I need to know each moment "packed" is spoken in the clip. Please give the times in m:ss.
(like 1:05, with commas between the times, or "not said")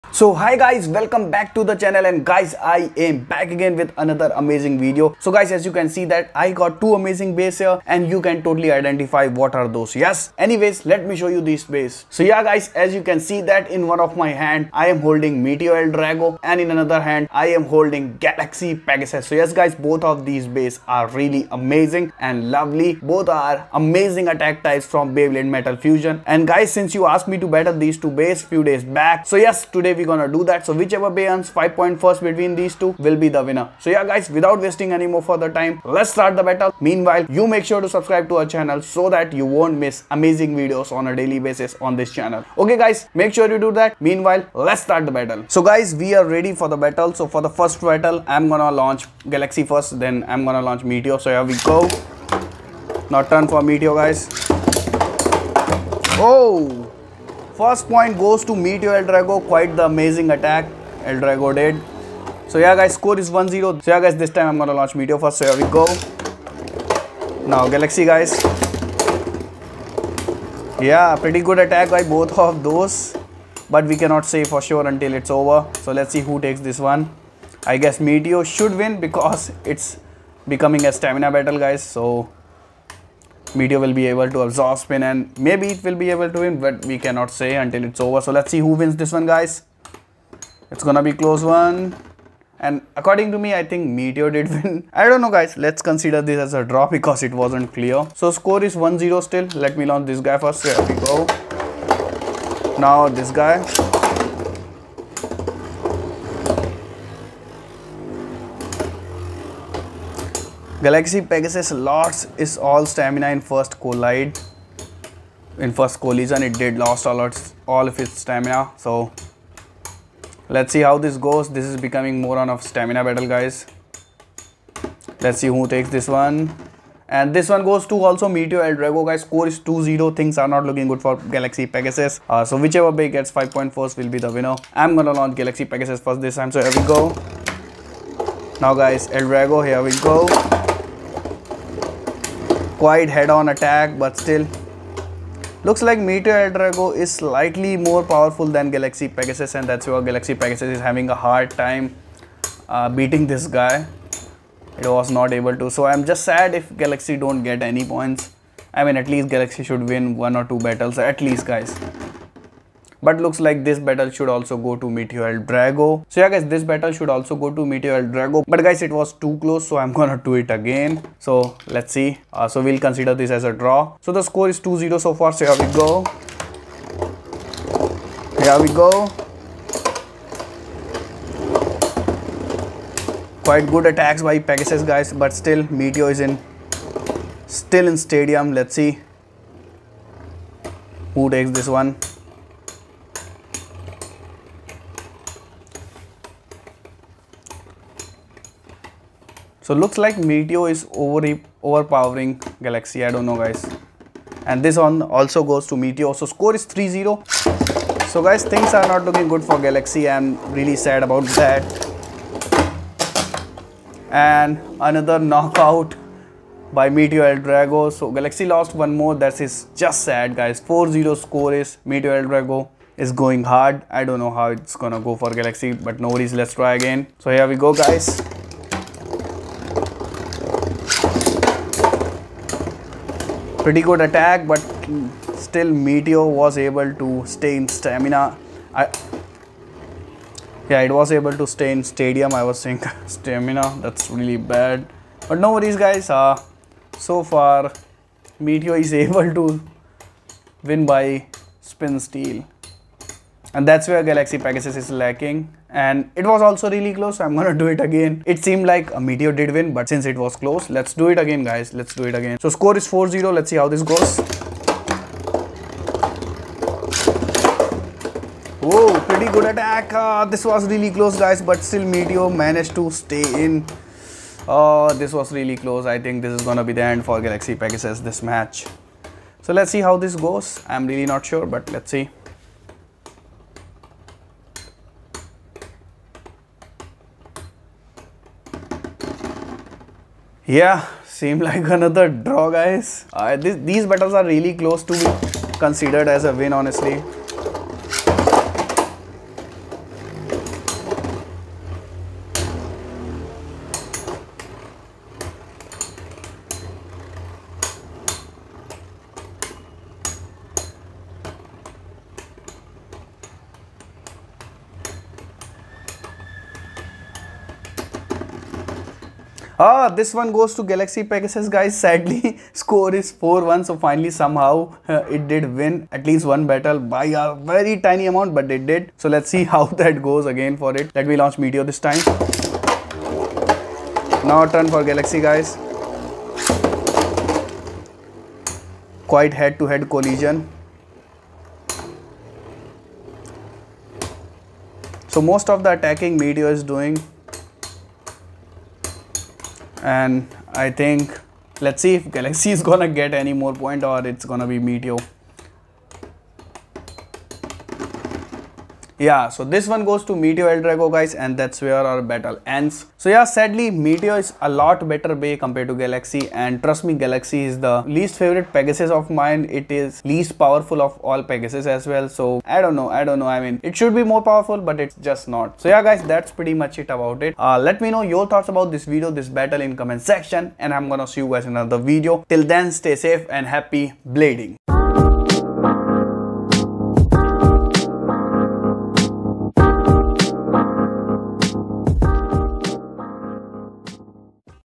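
not said.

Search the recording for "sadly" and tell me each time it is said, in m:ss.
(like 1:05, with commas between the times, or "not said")
5:21, 6:03.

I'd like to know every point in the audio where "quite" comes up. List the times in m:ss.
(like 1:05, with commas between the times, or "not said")
0:59, 2:22, 3:03, 5:39.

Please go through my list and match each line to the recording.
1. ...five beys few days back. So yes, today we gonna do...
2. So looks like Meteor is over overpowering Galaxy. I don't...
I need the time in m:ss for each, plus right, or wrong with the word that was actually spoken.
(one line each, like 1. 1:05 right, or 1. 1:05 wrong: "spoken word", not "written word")
1. 0:27 wrong: "two", not "five"
2. 3:19 right.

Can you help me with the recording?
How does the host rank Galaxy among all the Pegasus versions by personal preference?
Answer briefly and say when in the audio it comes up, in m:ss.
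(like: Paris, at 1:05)
least favorite, at 6:07.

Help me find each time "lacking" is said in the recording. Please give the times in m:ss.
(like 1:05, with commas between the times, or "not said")
4:14.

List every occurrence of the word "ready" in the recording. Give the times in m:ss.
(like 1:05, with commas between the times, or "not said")
0:46.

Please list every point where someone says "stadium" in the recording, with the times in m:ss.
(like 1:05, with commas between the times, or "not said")
3:07, 4:01.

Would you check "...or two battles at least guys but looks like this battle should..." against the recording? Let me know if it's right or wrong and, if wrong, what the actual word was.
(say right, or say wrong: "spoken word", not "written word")
right.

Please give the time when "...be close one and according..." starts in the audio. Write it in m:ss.
1:31.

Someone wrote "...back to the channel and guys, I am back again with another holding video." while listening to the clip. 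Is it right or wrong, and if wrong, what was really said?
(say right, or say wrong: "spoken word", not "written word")
wrong: "amazing", not "holding".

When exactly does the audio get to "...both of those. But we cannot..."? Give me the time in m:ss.
1:12.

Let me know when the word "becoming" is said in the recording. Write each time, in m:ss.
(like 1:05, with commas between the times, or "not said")
1:20, 2:01.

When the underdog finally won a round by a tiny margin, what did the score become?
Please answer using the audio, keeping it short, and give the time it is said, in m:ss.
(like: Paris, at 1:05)
4-1, at 5:23.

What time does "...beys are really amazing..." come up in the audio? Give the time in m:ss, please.
0:20.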